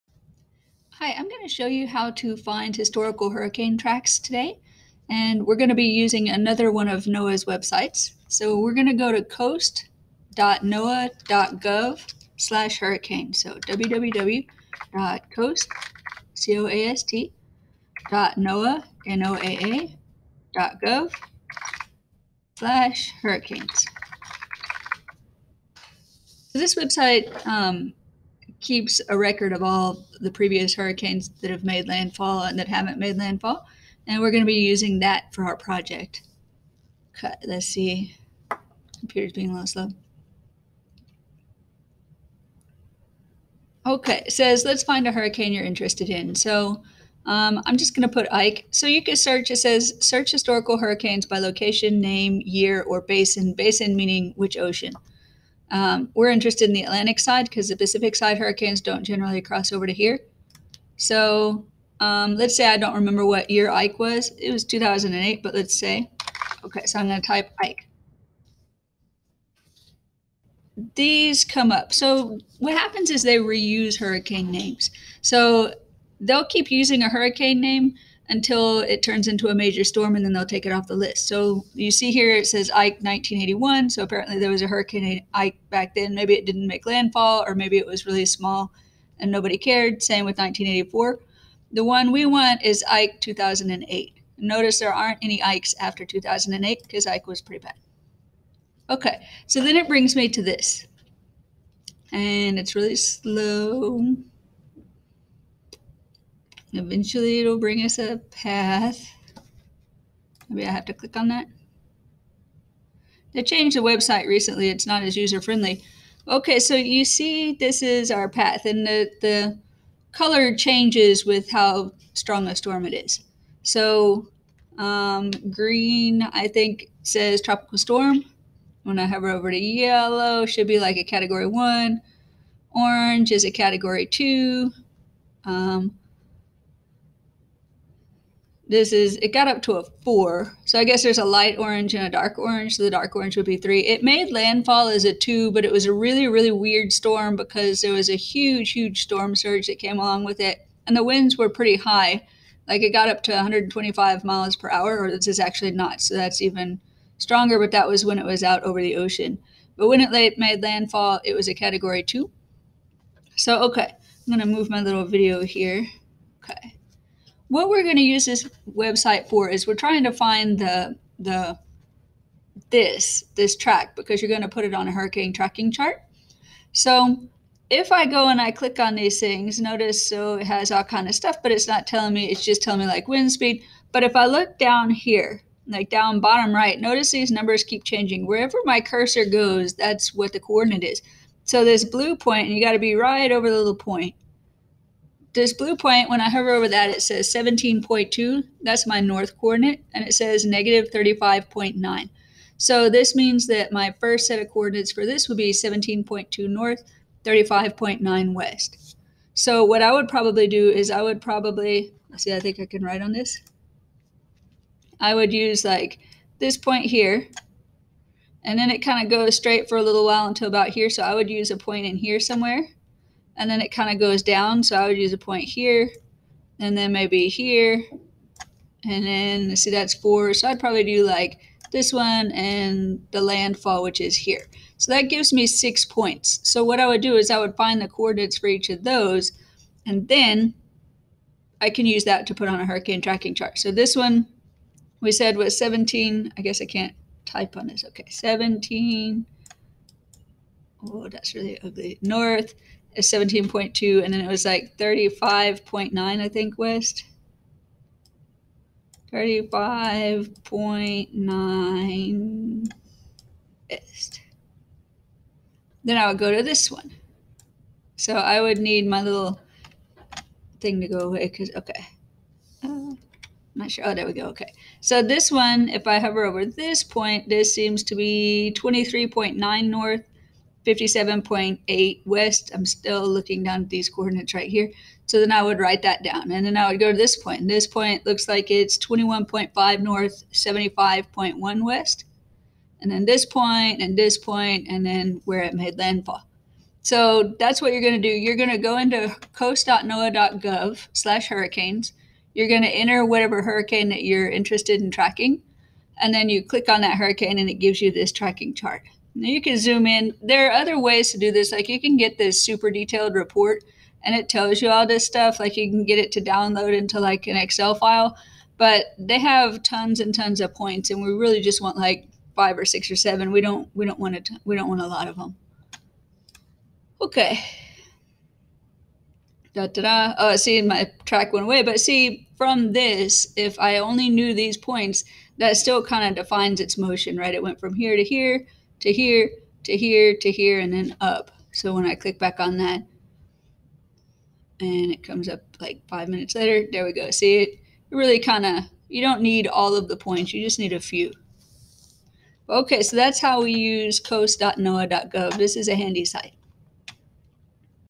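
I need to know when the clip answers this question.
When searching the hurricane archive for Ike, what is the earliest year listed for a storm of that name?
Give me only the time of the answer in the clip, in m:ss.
1:22.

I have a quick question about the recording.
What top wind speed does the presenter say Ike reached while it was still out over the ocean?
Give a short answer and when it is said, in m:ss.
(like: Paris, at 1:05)
125 miles per hour, at 2:33.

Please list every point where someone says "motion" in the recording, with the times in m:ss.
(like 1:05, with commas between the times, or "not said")
5:36.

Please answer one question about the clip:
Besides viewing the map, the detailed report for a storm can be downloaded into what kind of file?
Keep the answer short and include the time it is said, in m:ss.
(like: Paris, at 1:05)
Excel file, at 5:17.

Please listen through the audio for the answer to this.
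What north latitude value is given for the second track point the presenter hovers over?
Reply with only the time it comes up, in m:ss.
4:38.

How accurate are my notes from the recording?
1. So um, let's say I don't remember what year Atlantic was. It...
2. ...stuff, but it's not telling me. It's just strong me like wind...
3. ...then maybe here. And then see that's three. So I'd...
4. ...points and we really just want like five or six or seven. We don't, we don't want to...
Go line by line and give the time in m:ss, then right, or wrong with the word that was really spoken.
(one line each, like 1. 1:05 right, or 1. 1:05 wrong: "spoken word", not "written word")
1. 1:00 wrong: "Ike", not "Atlantic"
2. 3:01 wrong: "telling", not "strong"
3. 3:46 wrong: "four", not "three"
4. 5:20 right.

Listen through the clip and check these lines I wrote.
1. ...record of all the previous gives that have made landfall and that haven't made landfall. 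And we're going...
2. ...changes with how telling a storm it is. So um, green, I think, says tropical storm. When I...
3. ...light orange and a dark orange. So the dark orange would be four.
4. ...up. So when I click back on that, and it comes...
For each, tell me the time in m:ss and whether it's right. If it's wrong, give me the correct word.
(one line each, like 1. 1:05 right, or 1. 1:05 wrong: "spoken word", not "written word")
1. 0:29 wrong: "hurricanes", not "gives"
2. 2:00 wrong: "strong", not "telling"
3. 2:21 wrong: "three", not "four"
4. 5:41 right.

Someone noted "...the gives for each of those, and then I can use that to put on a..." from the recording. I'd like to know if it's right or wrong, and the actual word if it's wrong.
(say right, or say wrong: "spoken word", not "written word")
wrong: "coordinates", not "gives".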